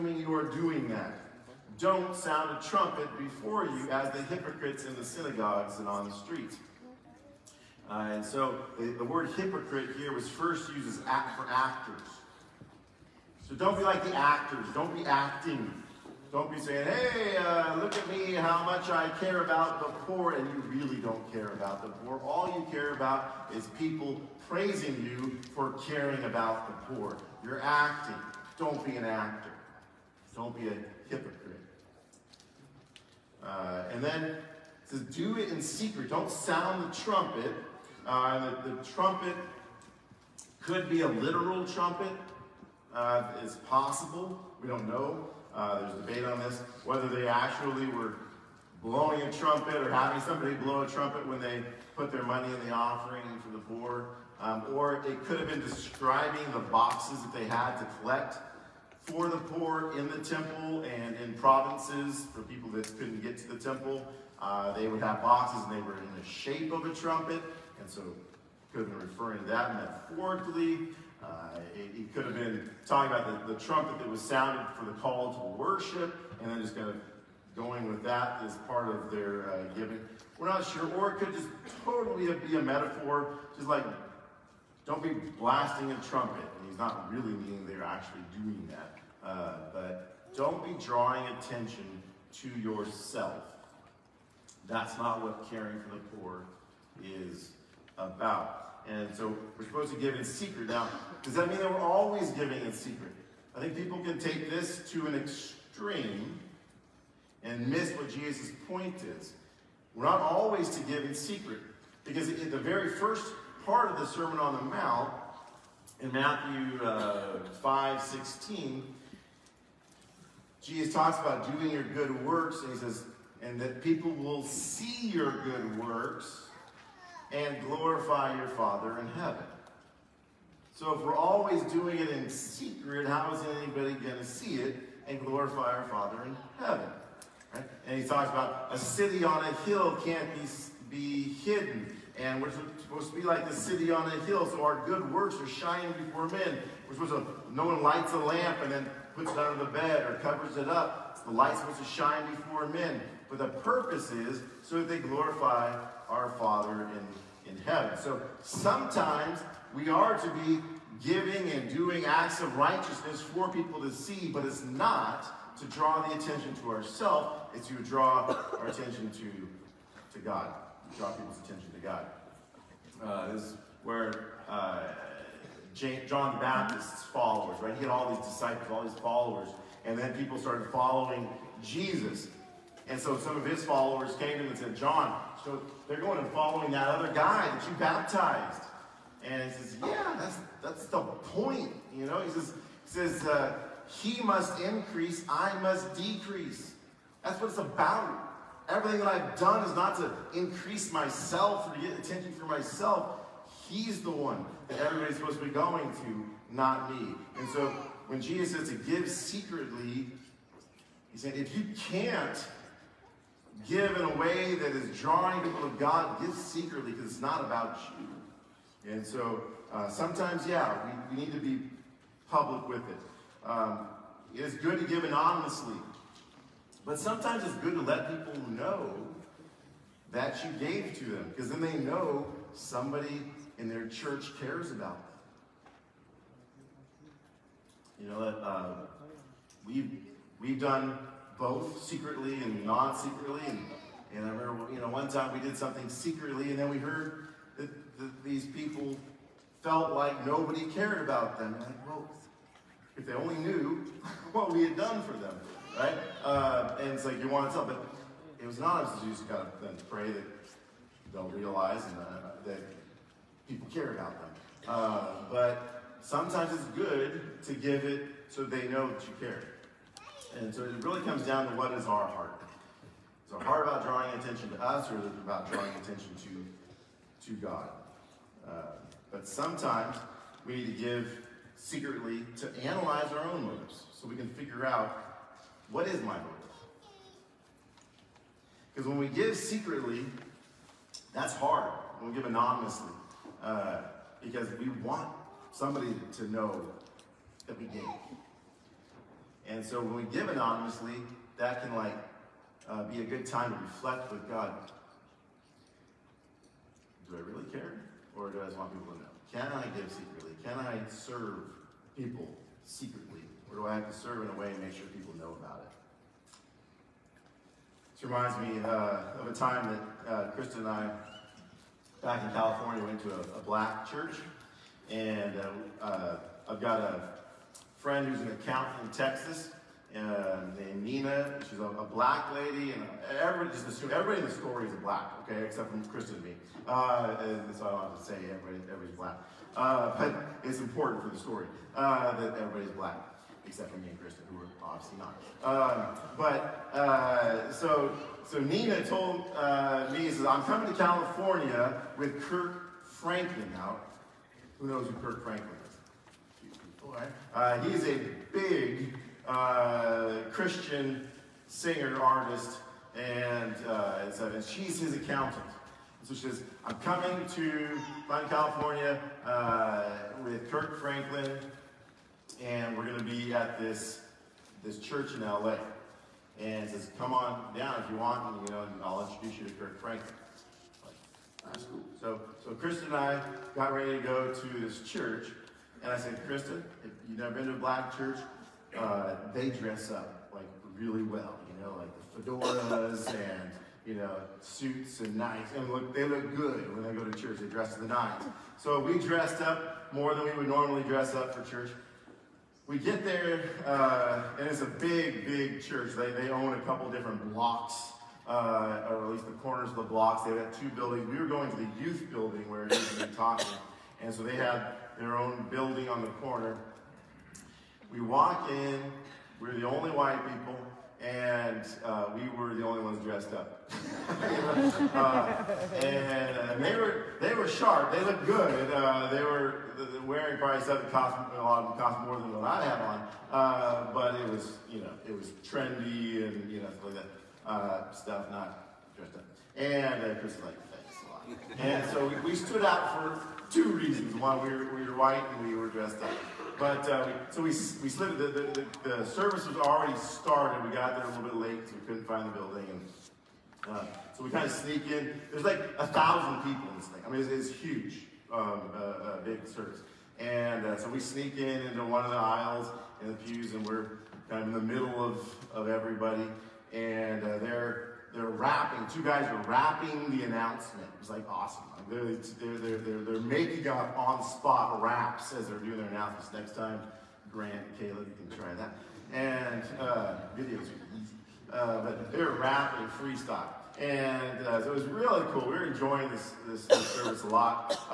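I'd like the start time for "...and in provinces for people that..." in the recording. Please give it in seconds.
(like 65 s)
60 s.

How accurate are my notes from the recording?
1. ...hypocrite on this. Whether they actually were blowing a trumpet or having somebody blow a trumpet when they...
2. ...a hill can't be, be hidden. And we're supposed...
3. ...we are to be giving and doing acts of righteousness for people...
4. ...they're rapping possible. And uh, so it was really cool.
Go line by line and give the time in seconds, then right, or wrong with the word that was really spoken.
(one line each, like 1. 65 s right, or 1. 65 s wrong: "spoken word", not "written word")
1. 46 s wrong: "debate", not "hypocrite"
2. 139 s right
3. 159 s right
4. 482 s wrong: "freestyle", not "possible".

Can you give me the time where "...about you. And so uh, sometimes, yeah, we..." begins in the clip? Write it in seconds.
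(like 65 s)
217 s.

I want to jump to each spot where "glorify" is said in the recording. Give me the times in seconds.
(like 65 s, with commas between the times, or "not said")
127 s, 135 s, 154 s.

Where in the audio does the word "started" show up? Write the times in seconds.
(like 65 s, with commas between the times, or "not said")
180 s, 449 s.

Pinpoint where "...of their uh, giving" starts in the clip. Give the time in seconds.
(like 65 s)
78 s.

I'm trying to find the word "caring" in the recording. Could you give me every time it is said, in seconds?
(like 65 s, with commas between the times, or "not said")
25 s, 95 s.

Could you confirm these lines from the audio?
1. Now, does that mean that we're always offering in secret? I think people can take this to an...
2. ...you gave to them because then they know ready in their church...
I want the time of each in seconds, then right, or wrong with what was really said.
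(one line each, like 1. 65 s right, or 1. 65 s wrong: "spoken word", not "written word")
1. 100 s wrong: "giving", not "offering"
2. 230 s wrong: "somebody", not "ready".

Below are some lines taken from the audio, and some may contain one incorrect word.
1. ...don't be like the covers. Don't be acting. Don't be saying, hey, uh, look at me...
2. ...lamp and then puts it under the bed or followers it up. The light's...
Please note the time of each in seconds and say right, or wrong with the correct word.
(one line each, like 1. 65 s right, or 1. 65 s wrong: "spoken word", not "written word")
1. 13 s wrong: "actors", not "covers"
2. 148 s wrong: "covers", not "followers".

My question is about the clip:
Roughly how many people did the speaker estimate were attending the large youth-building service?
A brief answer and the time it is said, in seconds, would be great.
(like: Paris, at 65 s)
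1000, at 455 s.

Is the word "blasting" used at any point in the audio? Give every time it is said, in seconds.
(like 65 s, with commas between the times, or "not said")
85 s.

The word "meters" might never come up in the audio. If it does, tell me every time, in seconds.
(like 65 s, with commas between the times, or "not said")
not said.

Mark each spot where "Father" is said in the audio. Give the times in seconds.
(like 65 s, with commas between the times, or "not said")
128 s, 135 s, 156 s.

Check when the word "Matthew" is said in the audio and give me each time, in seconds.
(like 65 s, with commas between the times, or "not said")
116 s.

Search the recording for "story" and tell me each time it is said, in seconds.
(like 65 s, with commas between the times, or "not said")
334 s, 341 s.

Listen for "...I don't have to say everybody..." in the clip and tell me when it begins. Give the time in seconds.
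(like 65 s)
337 s.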